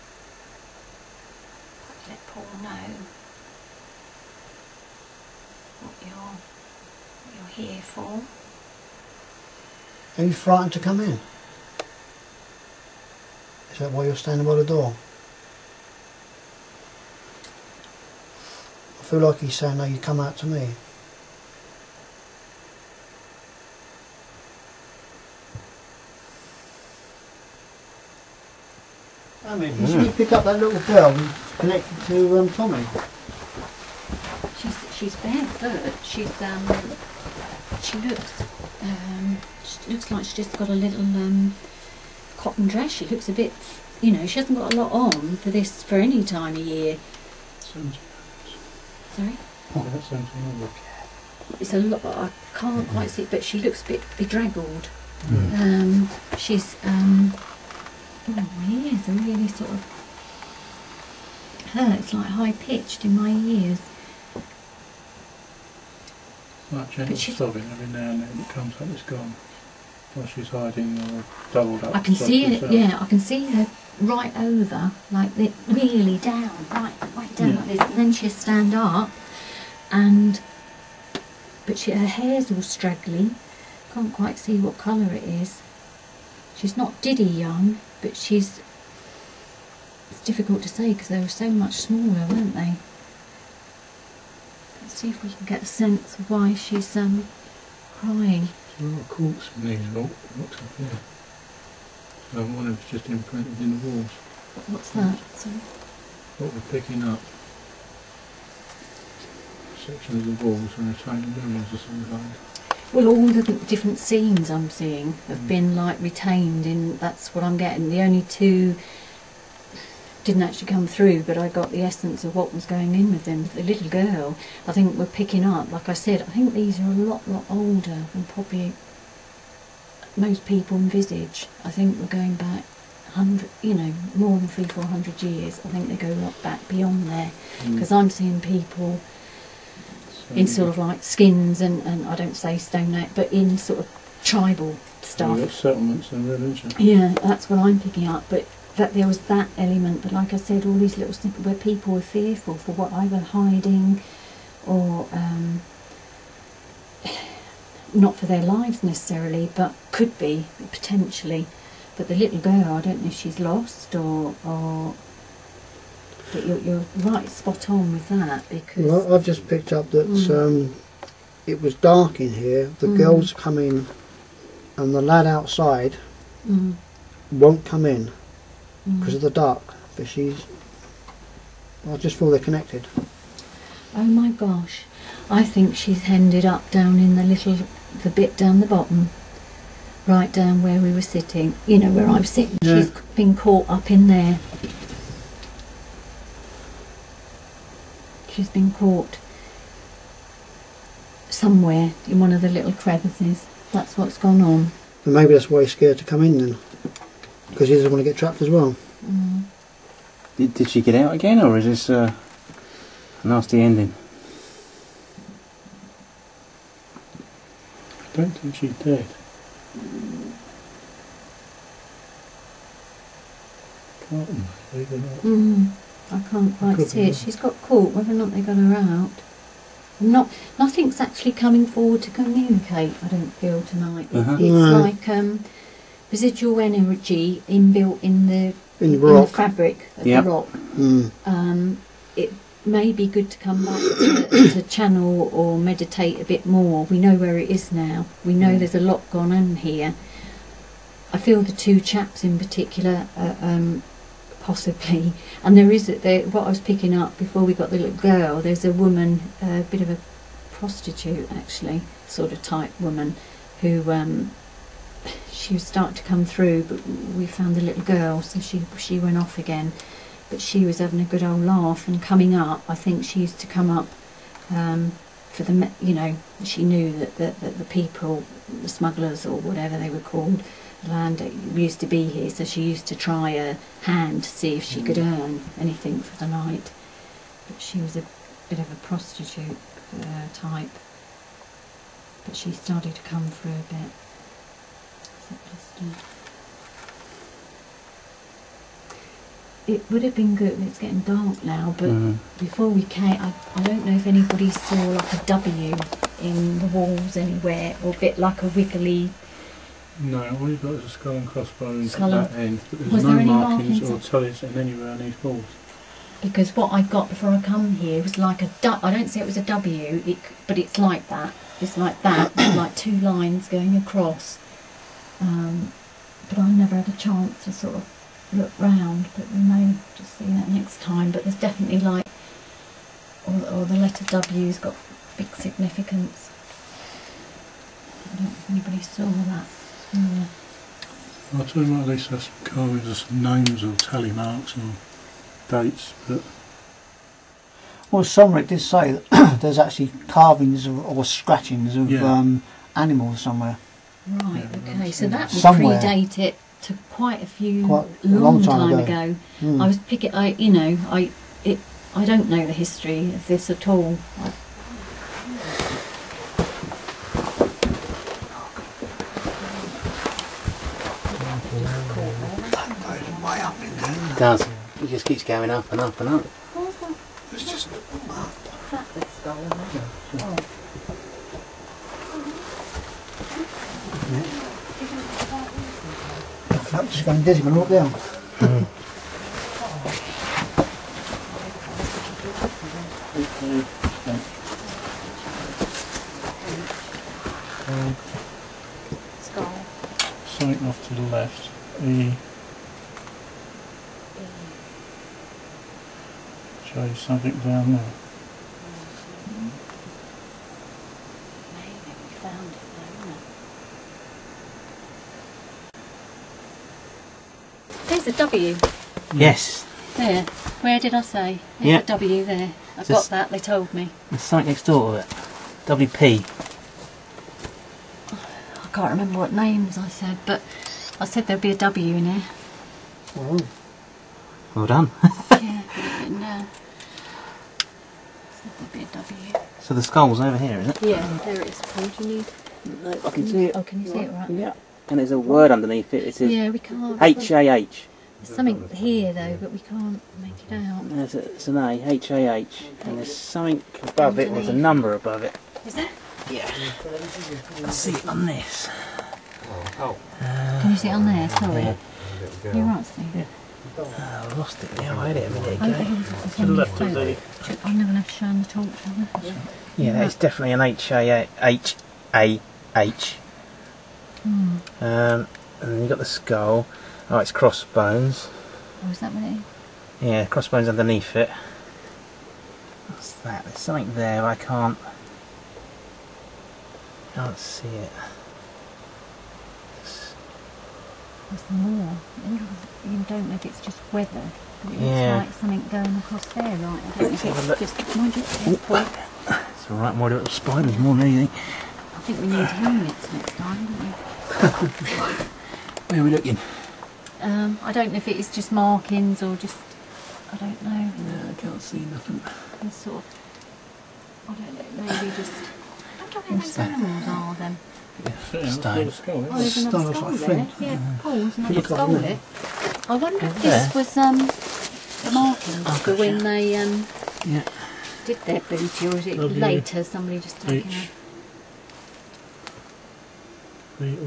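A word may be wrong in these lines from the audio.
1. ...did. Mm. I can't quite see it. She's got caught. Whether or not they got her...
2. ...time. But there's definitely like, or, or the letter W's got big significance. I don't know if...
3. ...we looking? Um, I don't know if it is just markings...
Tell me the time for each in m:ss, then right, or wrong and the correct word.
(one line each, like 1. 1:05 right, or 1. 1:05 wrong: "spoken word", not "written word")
1. 3:38 right
2. 5:30 right
3. 8:26 right.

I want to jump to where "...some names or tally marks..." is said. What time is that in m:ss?
5:42.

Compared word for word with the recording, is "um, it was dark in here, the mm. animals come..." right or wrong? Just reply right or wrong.
wrong.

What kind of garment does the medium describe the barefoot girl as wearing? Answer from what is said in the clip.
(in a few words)
cotton dress.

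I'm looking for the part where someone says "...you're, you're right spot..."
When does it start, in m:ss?
2:46.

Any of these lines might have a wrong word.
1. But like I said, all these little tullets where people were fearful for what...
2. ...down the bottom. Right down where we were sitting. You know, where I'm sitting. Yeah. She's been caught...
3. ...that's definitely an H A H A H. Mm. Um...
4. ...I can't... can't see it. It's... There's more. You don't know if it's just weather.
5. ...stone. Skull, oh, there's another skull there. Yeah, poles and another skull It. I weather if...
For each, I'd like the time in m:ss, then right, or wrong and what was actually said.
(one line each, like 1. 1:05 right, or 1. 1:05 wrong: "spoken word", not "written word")
1. 2:30 wrong: "snippets", not "tullets"
2. 3:08 right
3. 7:49 right
4. 8:04 right
5. 8:38 wrong: "wonder", not "weather".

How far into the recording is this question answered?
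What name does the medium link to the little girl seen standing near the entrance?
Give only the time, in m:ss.
0:32.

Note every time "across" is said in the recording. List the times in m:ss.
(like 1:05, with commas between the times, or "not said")
5:23, 8:15.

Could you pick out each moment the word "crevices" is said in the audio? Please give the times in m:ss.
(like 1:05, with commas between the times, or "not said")
3:22.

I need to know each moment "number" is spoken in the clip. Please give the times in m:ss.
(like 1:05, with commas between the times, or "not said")
7:34.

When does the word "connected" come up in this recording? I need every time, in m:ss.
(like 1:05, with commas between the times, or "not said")
0:31, 3:02.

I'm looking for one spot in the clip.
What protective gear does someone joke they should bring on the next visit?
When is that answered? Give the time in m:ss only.
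8:22.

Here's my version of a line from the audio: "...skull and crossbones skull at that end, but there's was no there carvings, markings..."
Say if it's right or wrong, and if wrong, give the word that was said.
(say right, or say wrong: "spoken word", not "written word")
wrong: "markings", not "carvings".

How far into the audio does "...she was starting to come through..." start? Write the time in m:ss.
4:25.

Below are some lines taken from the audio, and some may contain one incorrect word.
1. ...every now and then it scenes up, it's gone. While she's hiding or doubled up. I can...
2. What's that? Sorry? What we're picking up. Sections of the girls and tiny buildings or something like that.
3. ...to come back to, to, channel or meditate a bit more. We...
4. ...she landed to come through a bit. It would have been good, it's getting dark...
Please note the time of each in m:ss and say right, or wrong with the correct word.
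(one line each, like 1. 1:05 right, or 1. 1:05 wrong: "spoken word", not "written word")
1. 1:07 wrong: "comes", not "scenes"
2. 1:44 wrong: "walls", not "girls"
3. 4:03 right
4. 4:52 wrong: "started", not "landed".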